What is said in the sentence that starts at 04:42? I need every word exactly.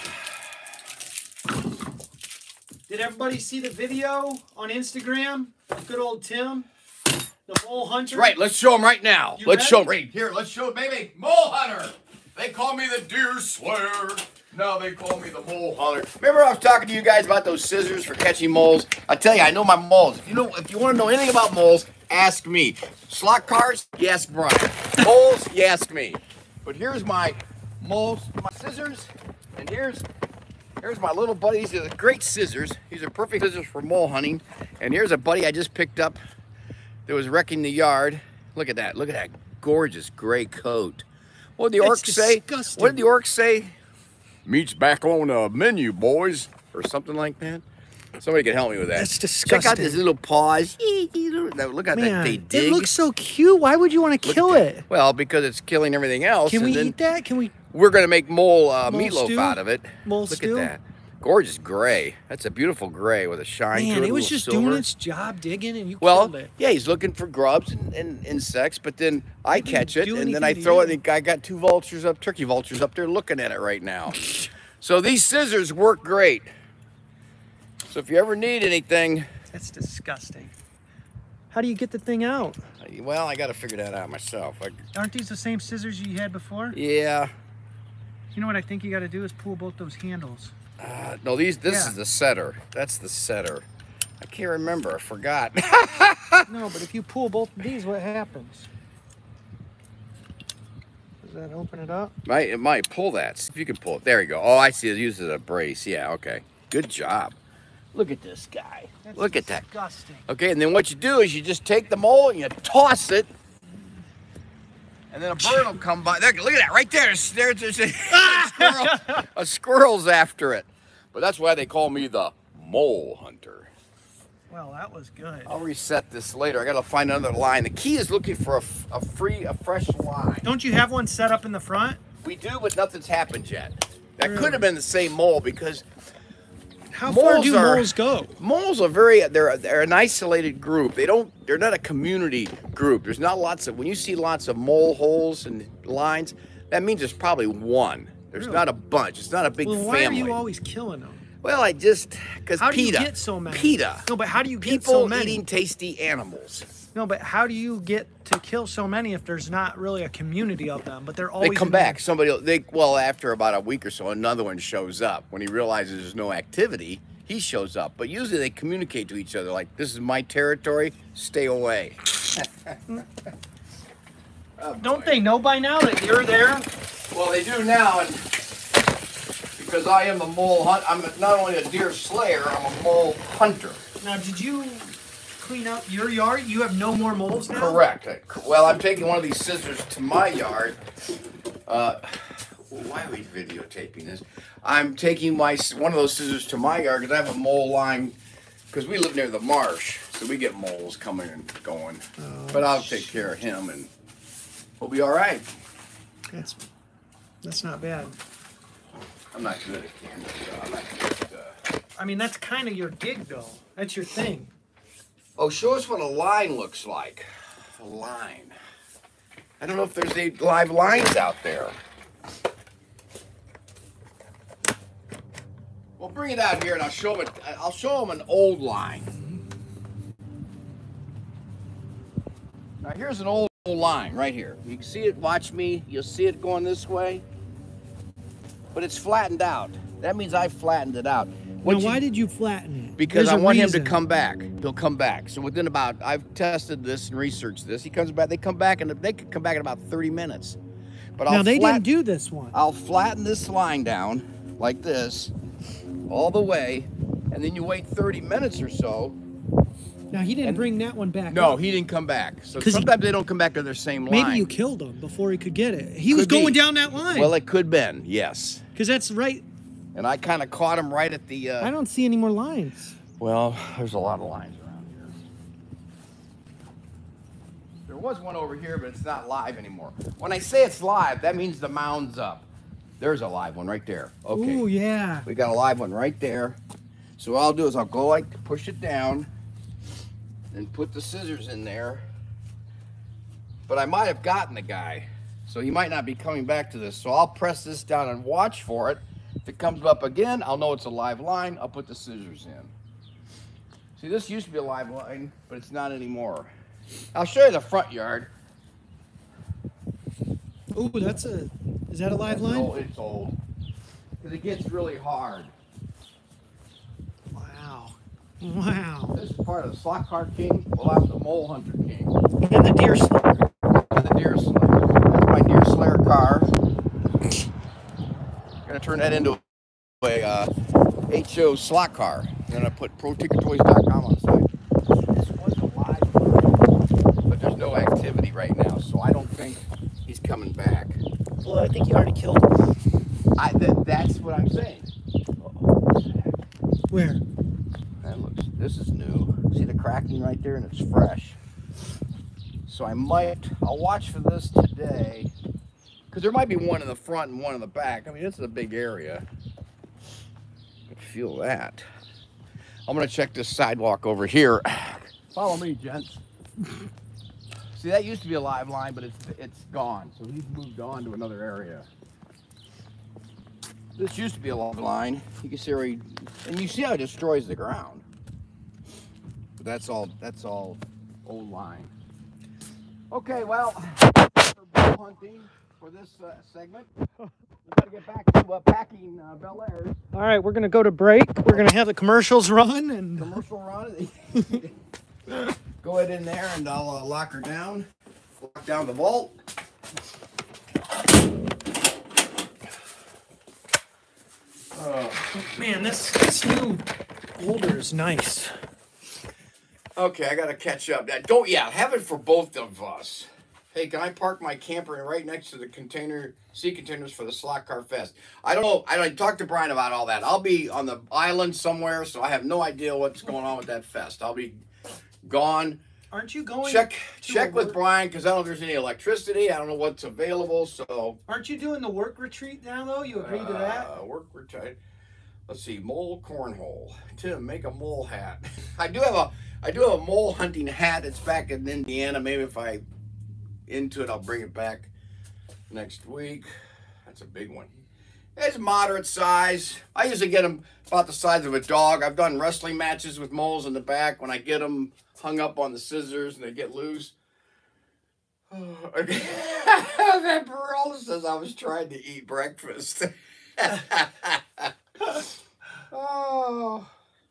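There's a live one right there.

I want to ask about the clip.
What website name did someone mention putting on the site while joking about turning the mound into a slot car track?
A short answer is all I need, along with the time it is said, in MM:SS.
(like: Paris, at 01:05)
ProTinkerToys.com, at 05:32.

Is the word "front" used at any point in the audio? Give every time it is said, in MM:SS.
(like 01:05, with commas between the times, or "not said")
02:11, 05:07, 05:56.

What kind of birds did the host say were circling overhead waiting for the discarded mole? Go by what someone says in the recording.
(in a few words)
Turkey vultures.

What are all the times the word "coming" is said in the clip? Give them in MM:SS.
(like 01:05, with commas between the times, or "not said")
03:20, 04:56, 05:40.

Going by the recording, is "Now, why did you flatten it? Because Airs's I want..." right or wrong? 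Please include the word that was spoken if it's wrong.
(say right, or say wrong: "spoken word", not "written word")
wrong: "There", not "Airs".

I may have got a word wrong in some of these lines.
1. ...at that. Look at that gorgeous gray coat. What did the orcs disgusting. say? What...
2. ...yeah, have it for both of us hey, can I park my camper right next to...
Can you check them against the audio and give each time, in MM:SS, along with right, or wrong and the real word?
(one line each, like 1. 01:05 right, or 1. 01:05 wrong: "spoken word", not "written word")
1. 00:38 right
2. 06:51 right.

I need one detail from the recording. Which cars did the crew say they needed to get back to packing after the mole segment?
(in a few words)
Bel Airs.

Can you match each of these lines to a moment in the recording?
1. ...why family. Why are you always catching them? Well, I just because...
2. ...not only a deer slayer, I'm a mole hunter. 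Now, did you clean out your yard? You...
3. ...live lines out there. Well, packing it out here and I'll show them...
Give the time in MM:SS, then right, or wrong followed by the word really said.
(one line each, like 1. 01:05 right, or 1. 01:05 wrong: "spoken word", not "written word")
1. 02:29 wrong: "killing", not "catching"
2. 03:01 right
3. 03:40 wrong: "bring", not "packing".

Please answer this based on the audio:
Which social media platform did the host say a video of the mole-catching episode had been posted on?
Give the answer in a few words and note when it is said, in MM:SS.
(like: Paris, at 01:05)
Instagram, at 00:04.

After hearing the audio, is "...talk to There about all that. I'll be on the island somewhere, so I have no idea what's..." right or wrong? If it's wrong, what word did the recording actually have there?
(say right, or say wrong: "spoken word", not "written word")
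wrong: "Brian", not "There".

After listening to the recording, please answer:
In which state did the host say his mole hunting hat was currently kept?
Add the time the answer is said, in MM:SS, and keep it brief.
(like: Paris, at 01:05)
Indiana, at 07:21.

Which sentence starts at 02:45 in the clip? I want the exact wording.
When he realizes there's no activity, he shows up.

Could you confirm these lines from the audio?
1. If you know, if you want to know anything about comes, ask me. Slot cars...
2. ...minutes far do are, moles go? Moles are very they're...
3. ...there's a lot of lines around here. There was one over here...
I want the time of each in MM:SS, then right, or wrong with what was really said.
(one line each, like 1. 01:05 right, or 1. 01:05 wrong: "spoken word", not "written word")
1. 00:20 wrong: "moles", not "comes"
2. 02:17 wrong: "moles", not "minutes"
3. 04:33 right.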